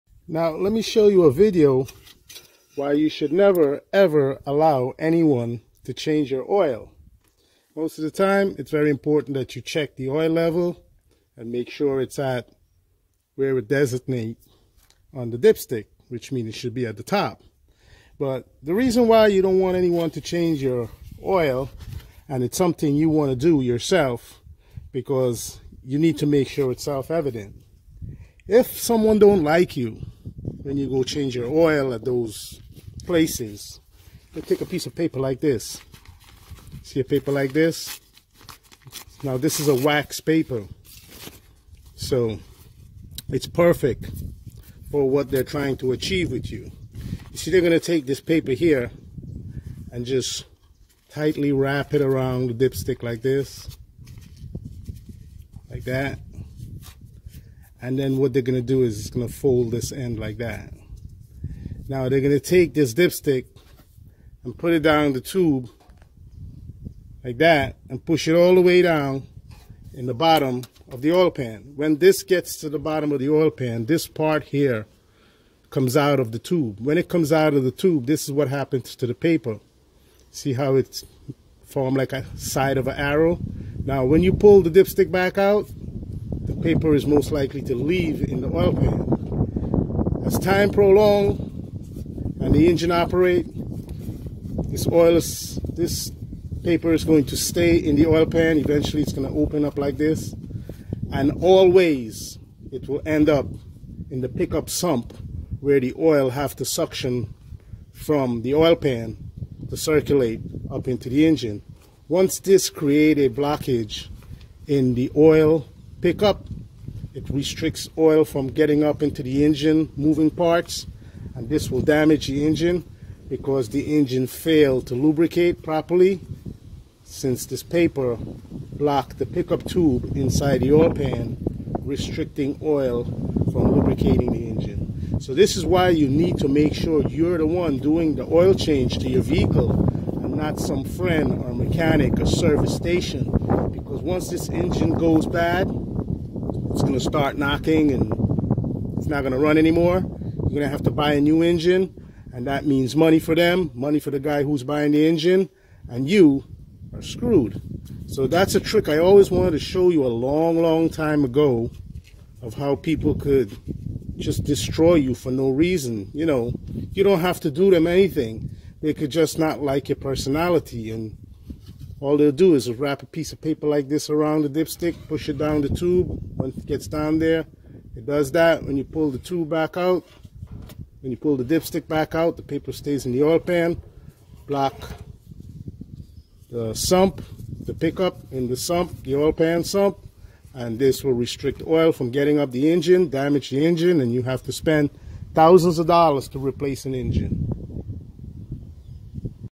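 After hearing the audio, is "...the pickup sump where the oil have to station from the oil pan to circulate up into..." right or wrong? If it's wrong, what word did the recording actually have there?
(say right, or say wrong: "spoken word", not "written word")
wrong: "suction", not "station".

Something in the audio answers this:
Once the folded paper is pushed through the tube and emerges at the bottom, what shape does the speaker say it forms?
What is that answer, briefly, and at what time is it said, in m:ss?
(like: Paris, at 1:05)
side of an arrow, at 1:22.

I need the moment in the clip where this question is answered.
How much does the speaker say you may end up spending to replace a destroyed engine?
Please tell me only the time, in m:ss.
3:15.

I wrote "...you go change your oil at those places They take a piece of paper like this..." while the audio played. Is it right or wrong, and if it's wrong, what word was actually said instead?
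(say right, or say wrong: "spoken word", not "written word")
right.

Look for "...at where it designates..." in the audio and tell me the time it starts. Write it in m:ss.
0:12.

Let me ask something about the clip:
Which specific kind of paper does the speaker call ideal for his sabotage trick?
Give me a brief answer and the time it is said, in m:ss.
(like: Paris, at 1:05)
wax paper, at 0:39.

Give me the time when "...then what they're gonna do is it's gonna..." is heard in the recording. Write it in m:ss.
0:57.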